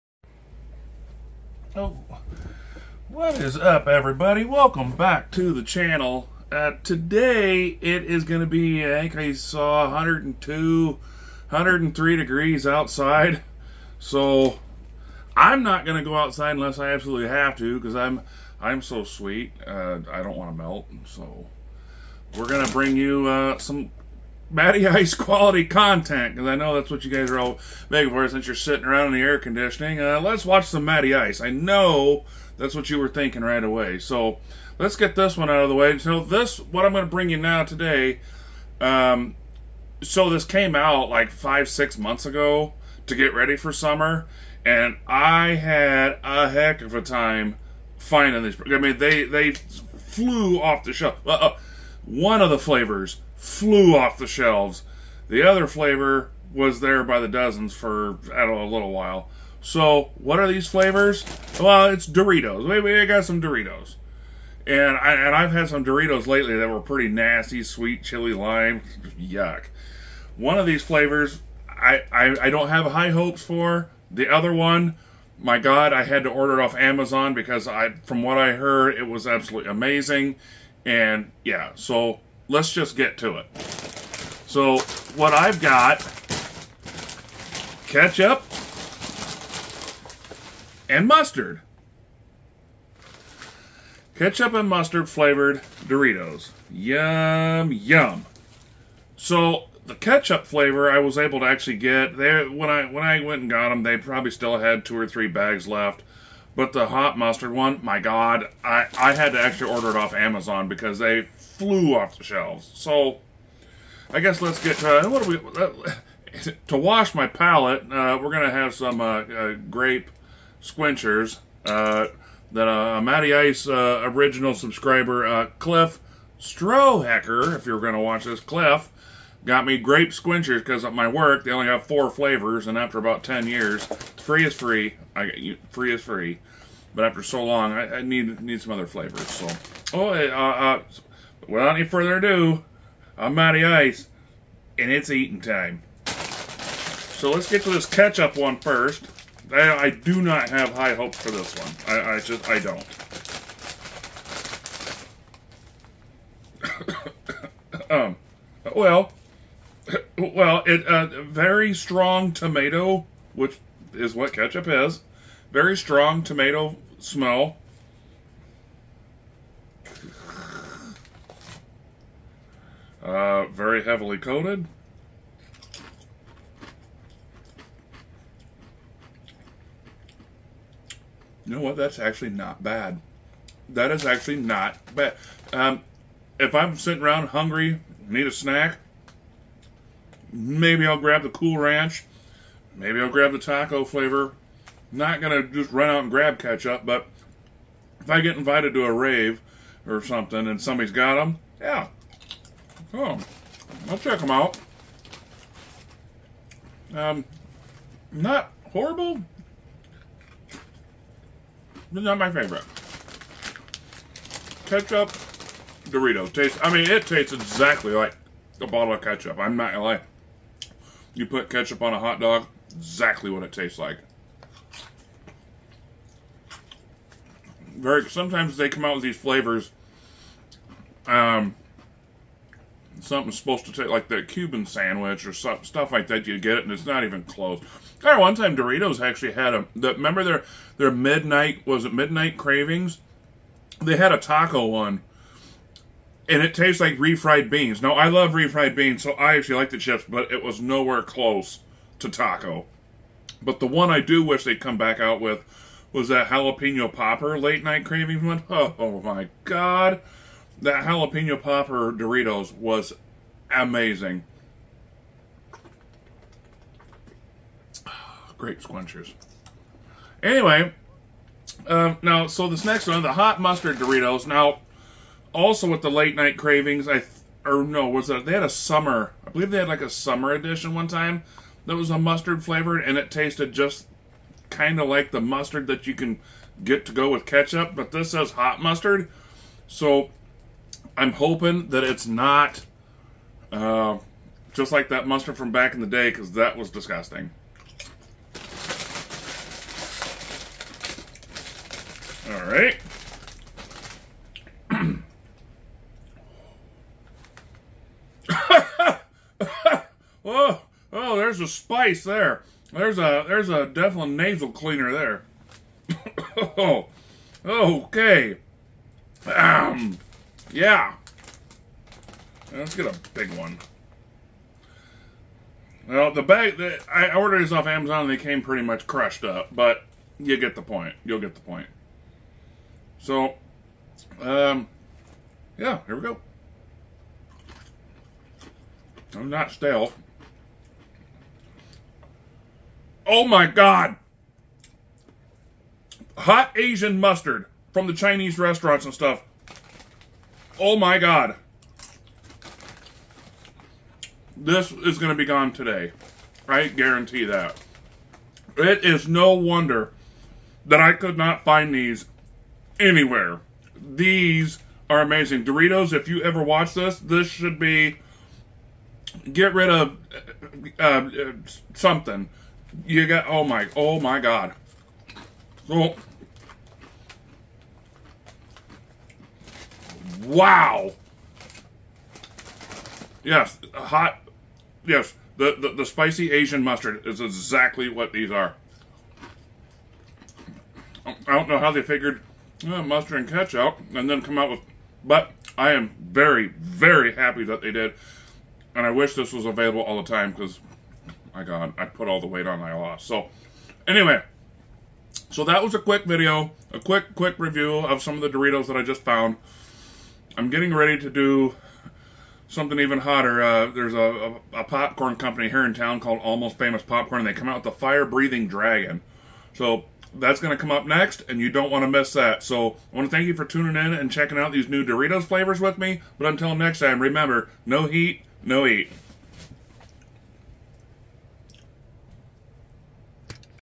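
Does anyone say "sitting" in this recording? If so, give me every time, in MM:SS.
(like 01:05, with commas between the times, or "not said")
00:28, 03:06.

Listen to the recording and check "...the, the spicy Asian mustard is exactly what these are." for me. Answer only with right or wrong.
right.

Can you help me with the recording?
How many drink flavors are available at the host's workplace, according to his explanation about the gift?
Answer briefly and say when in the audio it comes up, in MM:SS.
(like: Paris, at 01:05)
4, at 02:11.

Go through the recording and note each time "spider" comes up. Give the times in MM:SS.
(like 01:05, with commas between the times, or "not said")
not said.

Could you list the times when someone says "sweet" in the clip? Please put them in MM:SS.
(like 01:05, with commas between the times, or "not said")
00:19, 01:07.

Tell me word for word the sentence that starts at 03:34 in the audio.
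Ketchup Dorito tastes, I mean, it tastes exactly like a bottle of ketchup.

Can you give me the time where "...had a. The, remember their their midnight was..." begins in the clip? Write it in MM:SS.
03:59.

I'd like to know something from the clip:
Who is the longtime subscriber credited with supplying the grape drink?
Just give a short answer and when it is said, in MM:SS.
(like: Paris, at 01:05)
Cliff Strohacker, at 02:05.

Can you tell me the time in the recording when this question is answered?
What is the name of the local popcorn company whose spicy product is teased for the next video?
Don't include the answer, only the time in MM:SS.
06:56.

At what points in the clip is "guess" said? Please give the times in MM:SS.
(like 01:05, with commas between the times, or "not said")
01:54.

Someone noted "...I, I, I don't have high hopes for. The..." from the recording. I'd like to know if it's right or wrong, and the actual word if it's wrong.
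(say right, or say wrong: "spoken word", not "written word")
right.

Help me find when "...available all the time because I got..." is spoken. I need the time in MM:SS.
06:39.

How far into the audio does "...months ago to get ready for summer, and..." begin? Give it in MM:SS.
00:41.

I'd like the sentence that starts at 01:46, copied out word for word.
But the hot mustard one, my God, I, I had to actually order it off Amazon because they flew off the shelves.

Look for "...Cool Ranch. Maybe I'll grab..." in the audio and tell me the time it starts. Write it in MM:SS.
03:11.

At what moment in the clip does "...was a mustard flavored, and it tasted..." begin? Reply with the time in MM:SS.
04:41.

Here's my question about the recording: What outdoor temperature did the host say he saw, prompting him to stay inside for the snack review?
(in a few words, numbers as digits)
102 to 103 degrees.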